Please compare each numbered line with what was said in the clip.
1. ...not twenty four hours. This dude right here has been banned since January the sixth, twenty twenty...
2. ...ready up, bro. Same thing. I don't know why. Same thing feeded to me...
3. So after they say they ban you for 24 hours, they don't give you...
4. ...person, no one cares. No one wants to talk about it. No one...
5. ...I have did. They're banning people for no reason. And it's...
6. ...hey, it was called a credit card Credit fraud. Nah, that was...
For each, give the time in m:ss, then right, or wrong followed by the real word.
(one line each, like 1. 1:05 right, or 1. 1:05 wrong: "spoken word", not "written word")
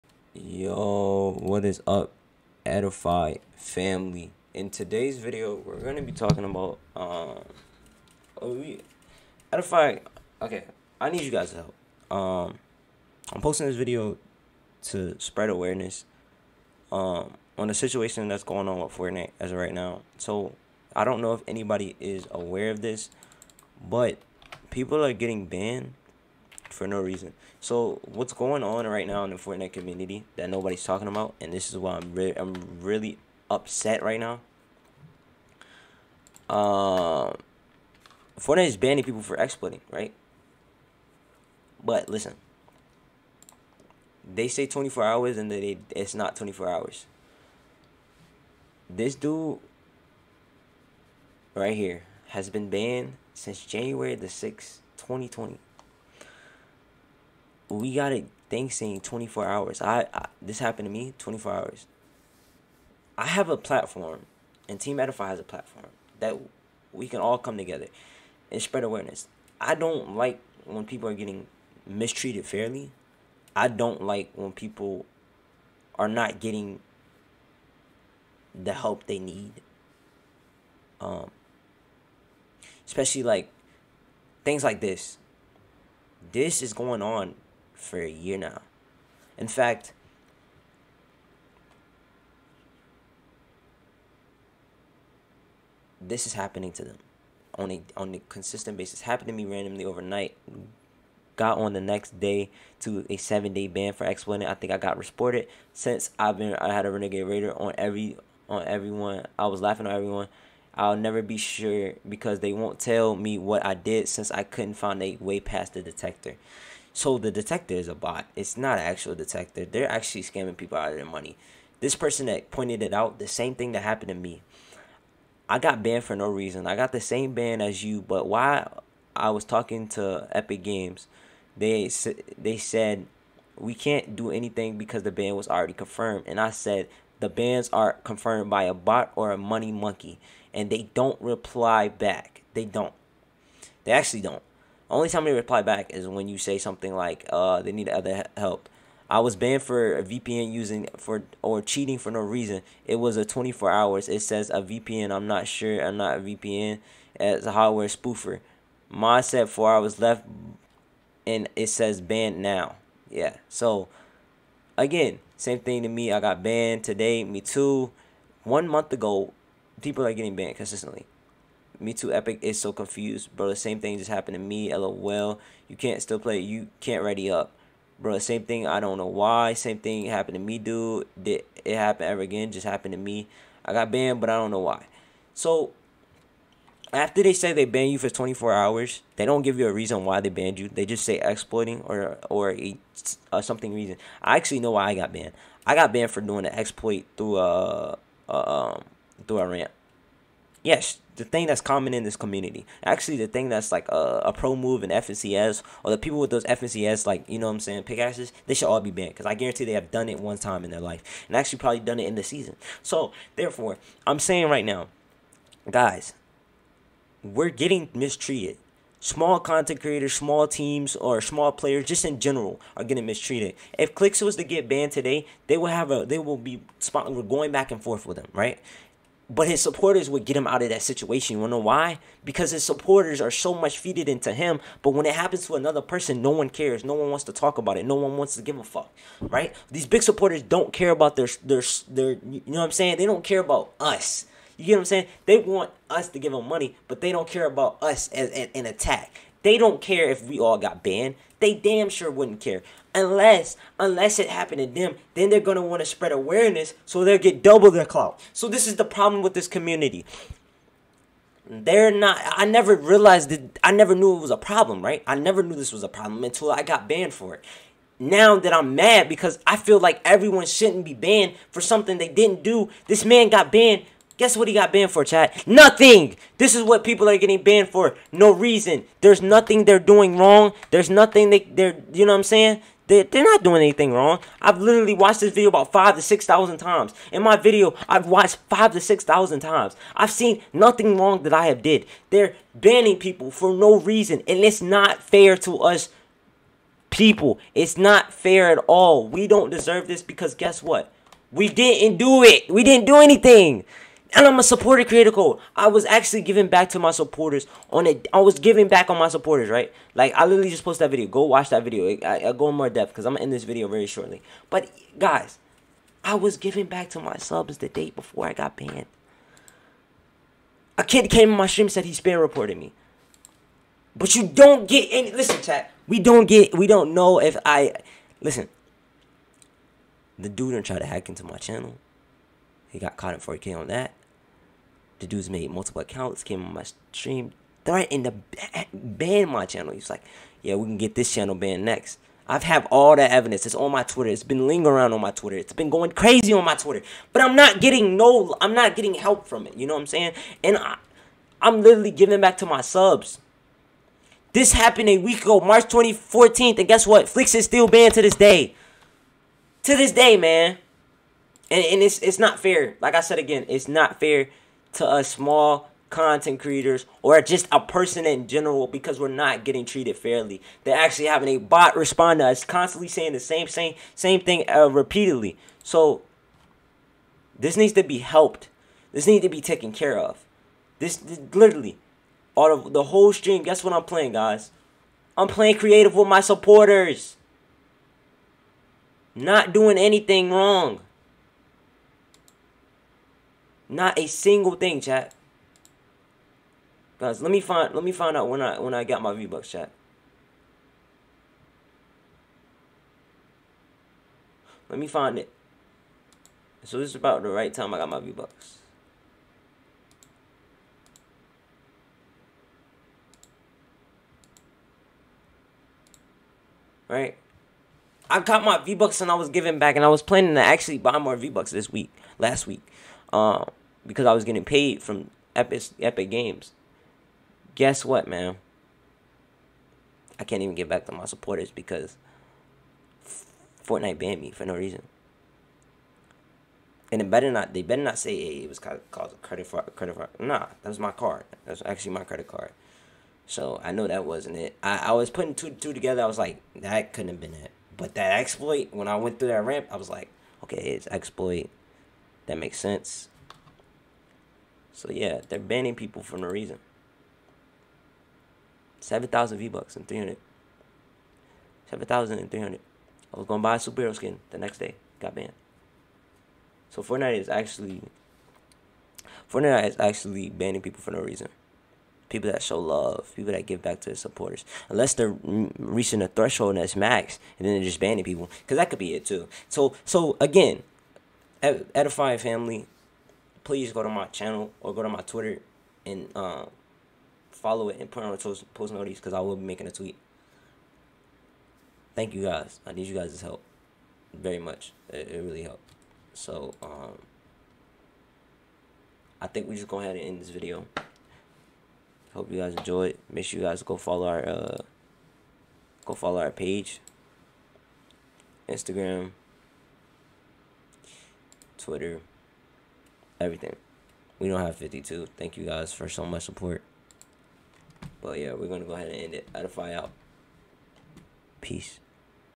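1. 0:46 right
2. 2:57 wrong: "happened", not "feeded"
3. 3:05 right
4. 3:55 right
5. 4:51 right
6. 7:18 right.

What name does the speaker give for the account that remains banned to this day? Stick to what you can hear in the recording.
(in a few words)
FLIZXS.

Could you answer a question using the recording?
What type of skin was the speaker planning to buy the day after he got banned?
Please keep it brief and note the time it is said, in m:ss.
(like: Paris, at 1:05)
superhero skin, at 7:43.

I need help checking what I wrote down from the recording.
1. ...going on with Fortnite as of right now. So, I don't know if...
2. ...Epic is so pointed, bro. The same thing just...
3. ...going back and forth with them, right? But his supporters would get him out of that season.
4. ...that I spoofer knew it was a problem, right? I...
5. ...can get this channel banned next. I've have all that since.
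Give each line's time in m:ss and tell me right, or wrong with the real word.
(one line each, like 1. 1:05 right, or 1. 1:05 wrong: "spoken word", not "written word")
1. 0:18 right
2. 2:52 wrong: "confused", not "pointed"
3. 3:47 wrong: "situation", not "season"
4. 4:23 wrong: "never", not "spoofer"
5. 5:40 wrong: "evidence", not "since".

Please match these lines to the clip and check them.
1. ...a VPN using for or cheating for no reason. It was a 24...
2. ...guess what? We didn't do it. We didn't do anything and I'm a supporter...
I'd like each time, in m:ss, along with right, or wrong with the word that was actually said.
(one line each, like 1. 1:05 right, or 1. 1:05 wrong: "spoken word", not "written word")
1. 2:29 right
2. 5:00 right.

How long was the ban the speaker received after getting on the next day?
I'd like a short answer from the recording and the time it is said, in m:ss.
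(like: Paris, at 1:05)
7 days, at 1:43.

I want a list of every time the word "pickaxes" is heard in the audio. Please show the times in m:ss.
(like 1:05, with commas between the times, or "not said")
3:27.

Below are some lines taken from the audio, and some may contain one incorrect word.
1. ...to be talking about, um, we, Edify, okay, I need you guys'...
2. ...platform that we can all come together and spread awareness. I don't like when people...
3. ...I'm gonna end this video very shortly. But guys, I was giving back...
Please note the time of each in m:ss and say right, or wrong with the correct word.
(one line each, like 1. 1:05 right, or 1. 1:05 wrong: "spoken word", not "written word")
1. 0:05 right
2. 1:05 right
3. 5:13 right.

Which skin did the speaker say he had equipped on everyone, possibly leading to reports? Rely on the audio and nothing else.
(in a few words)
Renegade Raider.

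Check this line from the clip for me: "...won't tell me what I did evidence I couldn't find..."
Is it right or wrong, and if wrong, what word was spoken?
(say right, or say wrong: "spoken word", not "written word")
wrong: "since", not "evidence".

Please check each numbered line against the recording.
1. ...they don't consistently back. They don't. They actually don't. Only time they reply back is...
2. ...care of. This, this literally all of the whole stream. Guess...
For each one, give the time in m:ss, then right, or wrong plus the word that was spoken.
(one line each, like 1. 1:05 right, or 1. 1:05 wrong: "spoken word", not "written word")
1. 2:20 wrong: "reply", not "consistently"
2. 6:19 right.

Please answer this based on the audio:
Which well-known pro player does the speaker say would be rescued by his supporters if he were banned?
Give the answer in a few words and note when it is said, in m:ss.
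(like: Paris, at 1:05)
Clix, at 3:43.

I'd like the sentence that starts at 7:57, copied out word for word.
And then they're just banning people.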